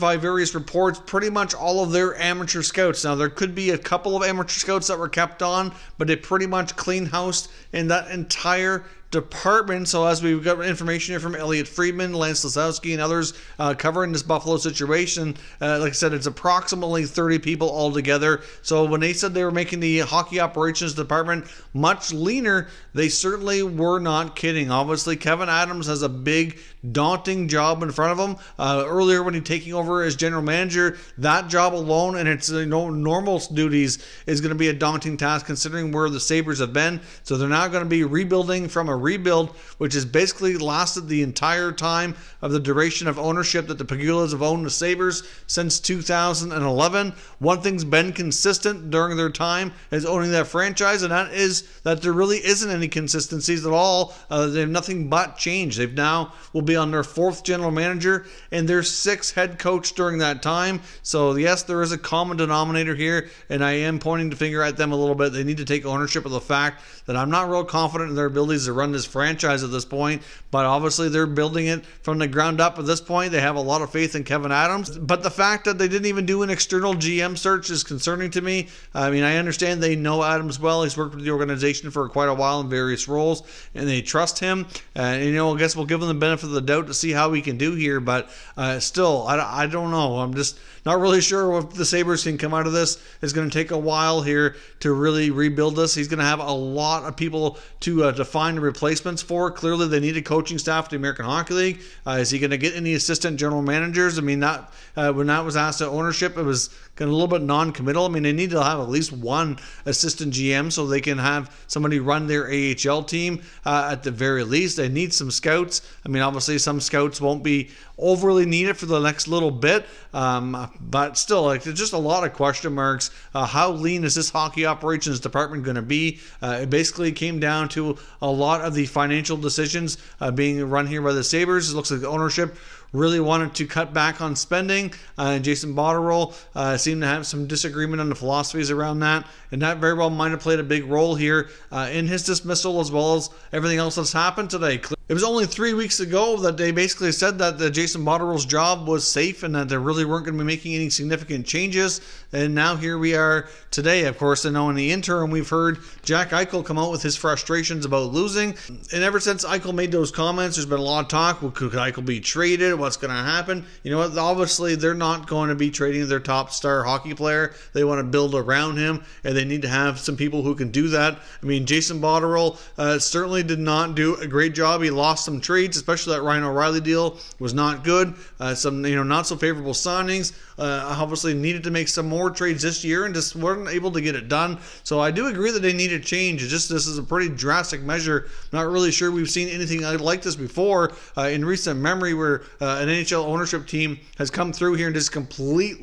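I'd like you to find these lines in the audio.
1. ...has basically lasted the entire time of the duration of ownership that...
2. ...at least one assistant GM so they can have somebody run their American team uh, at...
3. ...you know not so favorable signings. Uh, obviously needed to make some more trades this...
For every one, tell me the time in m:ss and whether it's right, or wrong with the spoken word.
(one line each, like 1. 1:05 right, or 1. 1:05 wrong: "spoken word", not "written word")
1. 0:39 right
2. 1:48 wrong: "AHL", not "American"
3. 2:58 right.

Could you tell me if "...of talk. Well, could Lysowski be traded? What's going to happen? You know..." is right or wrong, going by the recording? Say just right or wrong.
wrong.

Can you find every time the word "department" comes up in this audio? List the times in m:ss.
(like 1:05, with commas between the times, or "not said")
0:09, 0:20, 2:05.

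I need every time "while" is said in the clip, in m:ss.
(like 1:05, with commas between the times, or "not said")
1:22, 1:33.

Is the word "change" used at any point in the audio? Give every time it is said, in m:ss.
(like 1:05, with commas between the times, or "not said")
0:55, 2:31, 3:05.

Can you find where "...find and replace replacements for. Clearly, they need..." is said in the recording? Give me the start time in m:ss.
1:38.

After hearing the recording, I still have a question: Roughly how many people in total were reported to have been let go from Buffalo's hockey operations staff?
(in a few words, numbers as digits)
30.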